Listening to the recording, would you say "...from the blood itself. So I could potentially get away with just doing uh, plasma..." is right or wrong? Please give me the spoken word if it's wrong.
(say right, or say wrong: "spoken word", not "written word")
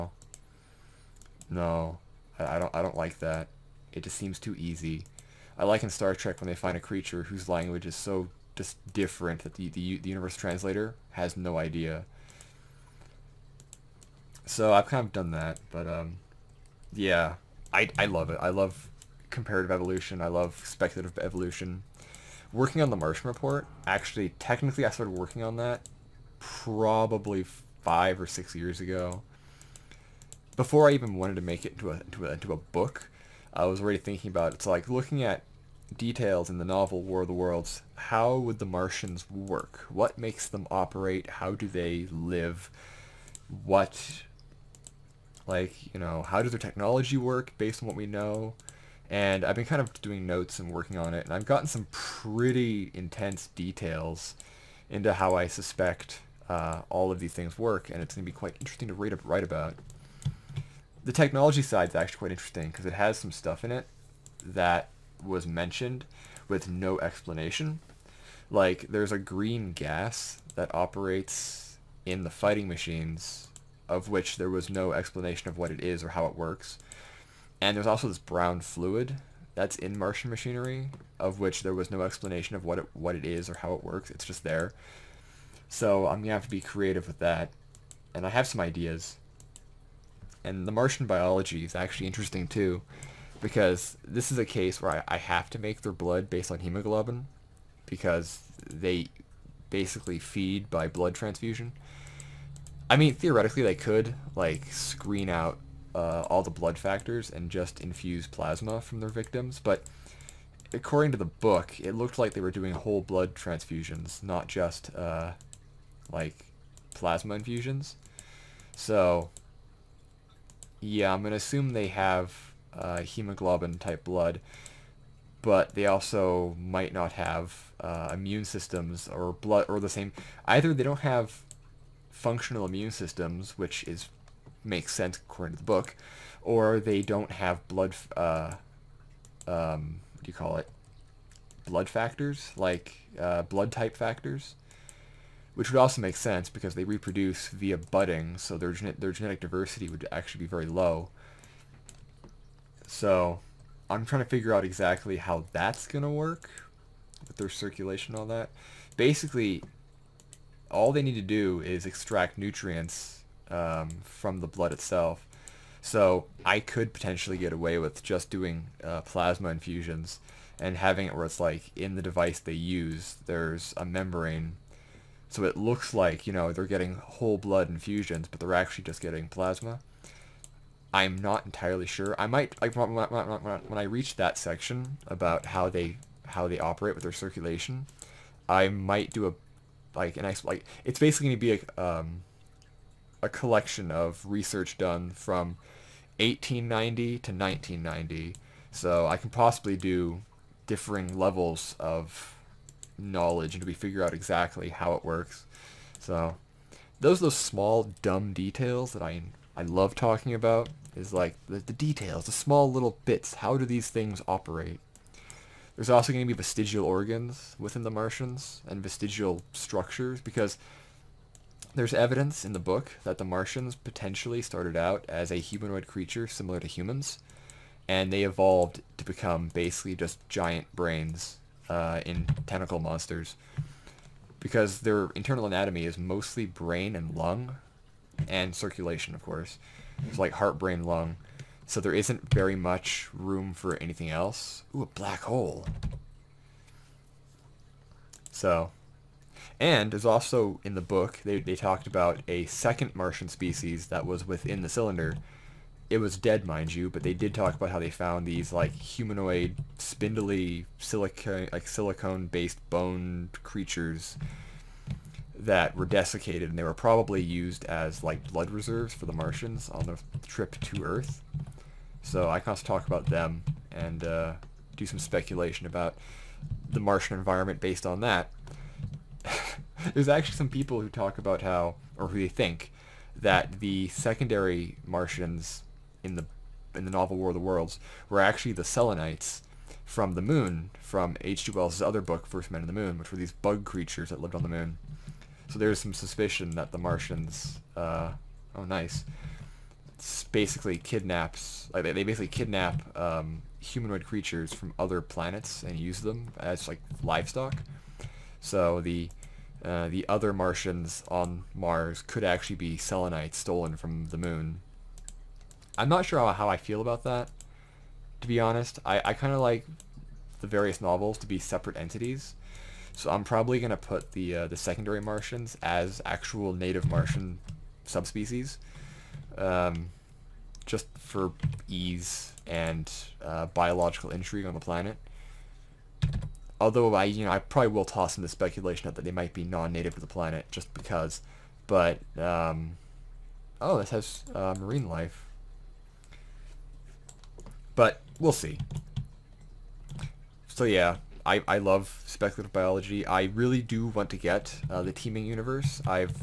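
right.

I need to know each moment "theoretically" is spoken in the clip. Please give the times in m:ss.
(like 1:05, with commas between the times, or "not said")
1:43.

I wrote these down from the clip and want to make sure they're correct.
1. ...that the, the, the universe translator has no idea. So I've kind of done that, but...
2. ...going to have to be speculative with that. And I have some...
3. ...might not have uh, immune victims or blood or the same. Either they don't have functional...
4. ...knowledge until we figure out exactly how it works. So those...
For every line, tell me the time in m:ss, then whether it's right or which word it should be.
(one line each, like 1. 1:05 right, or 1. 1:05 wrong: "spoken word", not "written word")
1. 0:09 right
2. 1:26 wrong: "creative", not "speculative"
3. 2:06 wrong: "systems", not "victims"
4. 3:22 right.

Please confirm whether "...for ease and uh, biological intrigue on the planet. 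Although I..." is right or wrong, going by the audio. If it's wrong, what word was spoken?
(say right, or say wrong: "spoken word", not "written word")
right.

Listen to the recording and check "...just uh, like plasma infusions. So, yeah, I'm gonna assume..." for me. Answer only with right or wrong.
right.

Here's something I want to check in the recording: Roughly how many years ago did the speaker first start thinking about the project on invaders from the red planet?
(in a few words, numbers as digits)
5 or 6 years.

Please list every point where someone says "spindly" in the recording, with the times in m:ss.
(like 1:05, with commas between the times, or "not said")
4:19.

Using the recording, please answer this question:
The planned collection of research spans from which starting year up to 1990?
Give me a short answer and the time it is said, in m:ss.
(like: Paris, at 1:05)
1890, at 3:16.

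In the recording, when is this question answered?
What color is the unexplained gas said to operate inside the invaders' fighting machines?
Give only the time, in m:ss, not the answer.
1:09.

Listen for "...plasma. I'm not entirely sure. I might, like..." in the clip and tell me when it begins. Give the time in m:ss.
2:59.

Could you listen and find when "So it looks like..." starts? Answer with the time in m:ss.
2:55.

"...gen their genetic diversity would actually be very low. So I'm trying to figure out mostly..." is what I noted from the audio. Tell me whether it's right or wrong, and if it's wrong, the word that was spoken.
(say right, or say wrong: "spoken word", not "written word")
wrong: "exactly", not "mostly".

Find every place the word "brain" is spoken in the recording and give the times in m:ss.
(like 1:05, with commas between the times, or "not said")
3:50, 3:56, 4:00.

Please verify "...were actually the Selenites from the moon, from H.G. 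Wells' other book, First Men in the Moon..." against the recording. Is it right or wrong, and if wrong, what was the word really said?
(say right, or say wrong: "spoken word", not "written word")
right.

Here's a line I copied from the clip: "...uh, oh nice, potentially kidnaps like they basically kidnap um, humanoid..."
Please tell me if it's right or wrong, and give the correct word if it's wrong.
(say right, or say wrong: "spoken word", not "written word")
wrong: "basically", not "potentially".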